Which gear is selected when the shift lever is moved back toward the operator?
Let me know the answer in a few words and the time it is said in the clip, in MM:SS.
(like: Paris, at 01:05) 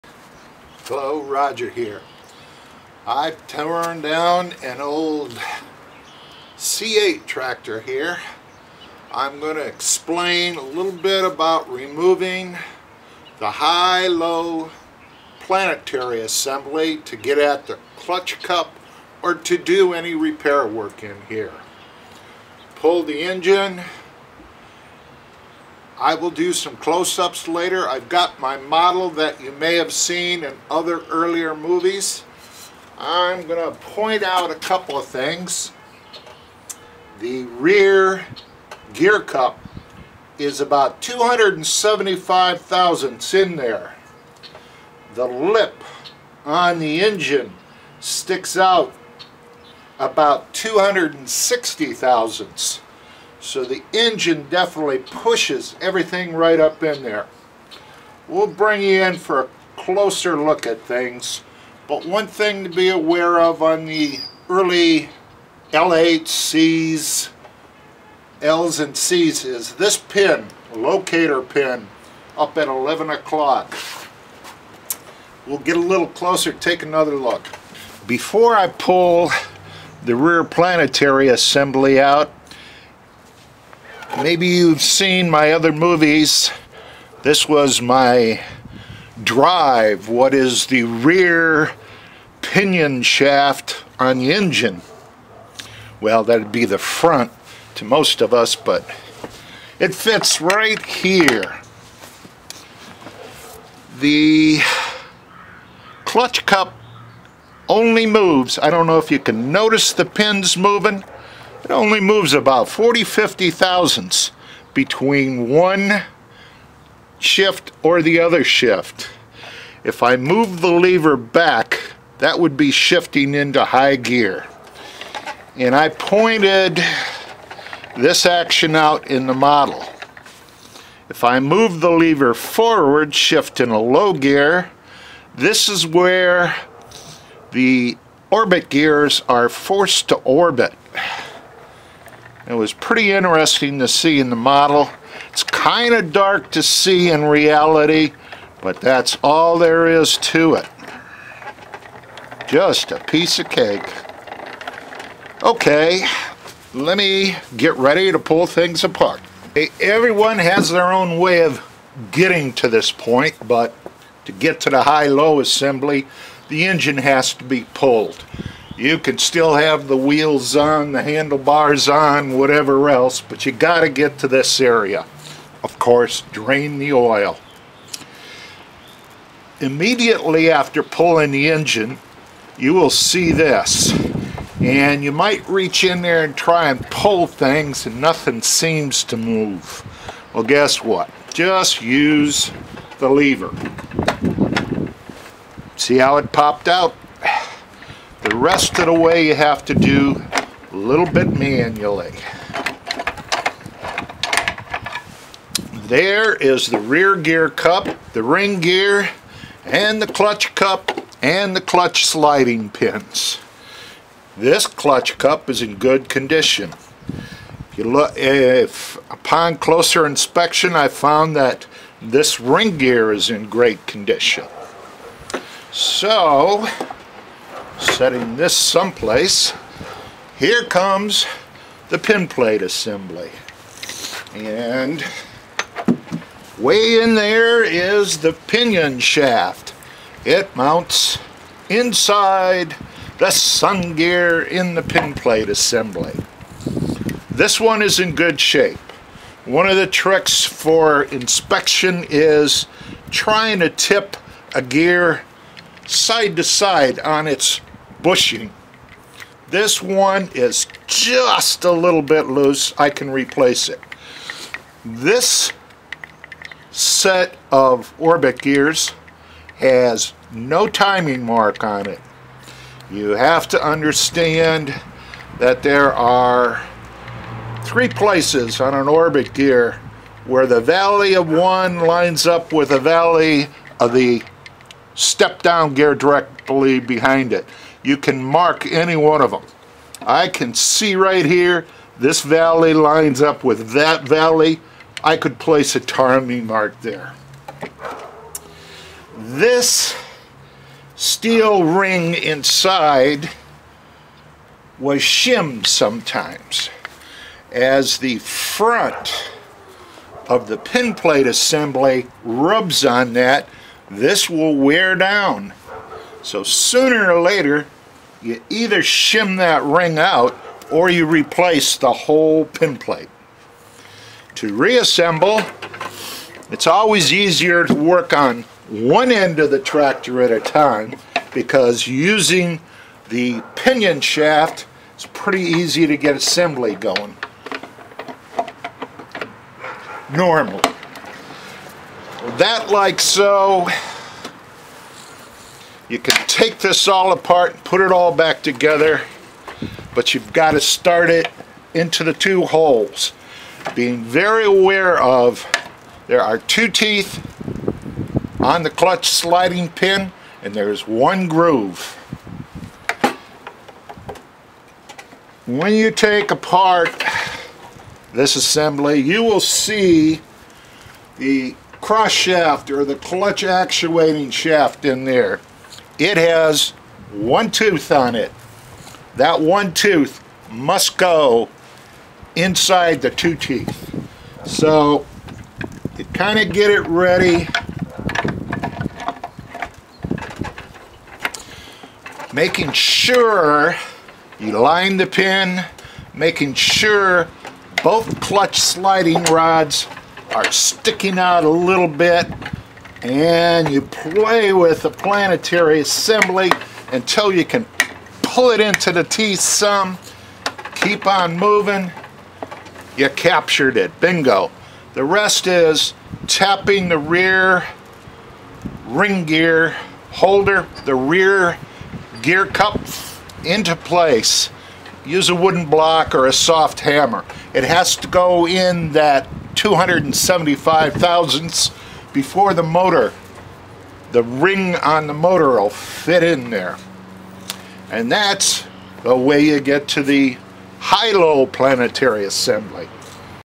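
High gear, at 02:03.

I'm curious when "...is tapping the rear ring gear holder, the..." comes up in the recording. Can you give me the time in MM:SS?
06:55.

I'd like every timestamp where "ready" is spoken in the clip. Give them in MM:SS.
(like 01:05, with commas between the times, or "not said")
02:37, 06:26.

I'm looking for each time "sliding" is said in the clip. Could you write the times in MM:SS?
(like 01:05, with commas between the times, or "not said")
03:32, 05:59, 06:38.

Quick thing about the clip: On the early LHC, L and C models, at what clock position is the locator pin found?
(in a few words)
11 o'clock.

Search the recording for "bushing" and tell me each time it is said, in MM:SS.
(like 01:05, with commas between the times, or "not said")
04:18.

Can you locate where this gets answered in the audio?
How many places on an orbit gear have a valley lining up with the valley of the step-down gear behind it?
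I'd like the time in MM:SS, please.
04:37.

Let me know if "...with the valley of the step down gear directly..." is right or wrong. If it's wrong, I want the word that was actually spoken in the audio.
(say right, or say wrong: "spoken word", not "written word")
right.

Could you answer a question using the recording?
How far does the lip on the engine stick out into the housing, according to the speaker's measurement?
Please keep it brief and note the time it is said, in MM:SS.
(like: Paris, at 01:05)
260 thousandths, at 00:50.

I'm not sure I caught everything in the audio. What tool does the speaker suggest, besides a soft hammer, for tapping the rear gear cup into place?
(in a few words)
A wooden block.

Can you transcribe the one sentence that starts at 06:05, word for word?
When you take apart this assembly, you will see the cross shaft or the clutch actuating shaft in there.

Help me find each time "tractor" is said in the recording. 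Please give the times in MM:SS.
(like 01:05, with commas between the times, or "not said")
00:07, 05:29.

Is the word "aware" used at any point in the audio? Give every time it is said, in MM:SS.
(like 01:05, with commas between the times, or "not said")
01:02, 05:54.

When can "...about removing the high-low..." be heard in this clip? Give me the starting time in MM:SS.
00:11.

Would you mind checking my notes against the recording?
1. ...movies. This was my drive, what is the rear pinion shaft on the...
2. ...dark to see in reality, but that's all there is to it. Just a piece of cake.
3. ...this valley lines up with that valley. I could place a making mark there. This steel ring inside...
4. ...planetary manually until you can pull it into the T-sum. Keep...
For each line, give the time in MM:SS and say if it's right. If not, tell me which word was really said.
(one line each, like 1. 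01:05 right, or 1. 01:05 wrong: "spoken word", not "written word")
1. 01:25 right
2. 02:26 right
3. 04:51 wrong: "timing", not "making"
4. 06:44 wrong: "assembly", not "manually".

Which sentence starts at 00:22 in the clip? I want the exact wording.
Pull the engine, I will do some close-ups later.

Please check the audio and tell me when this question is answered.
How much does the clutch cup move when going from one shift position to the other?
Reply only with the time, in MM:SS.
01:52.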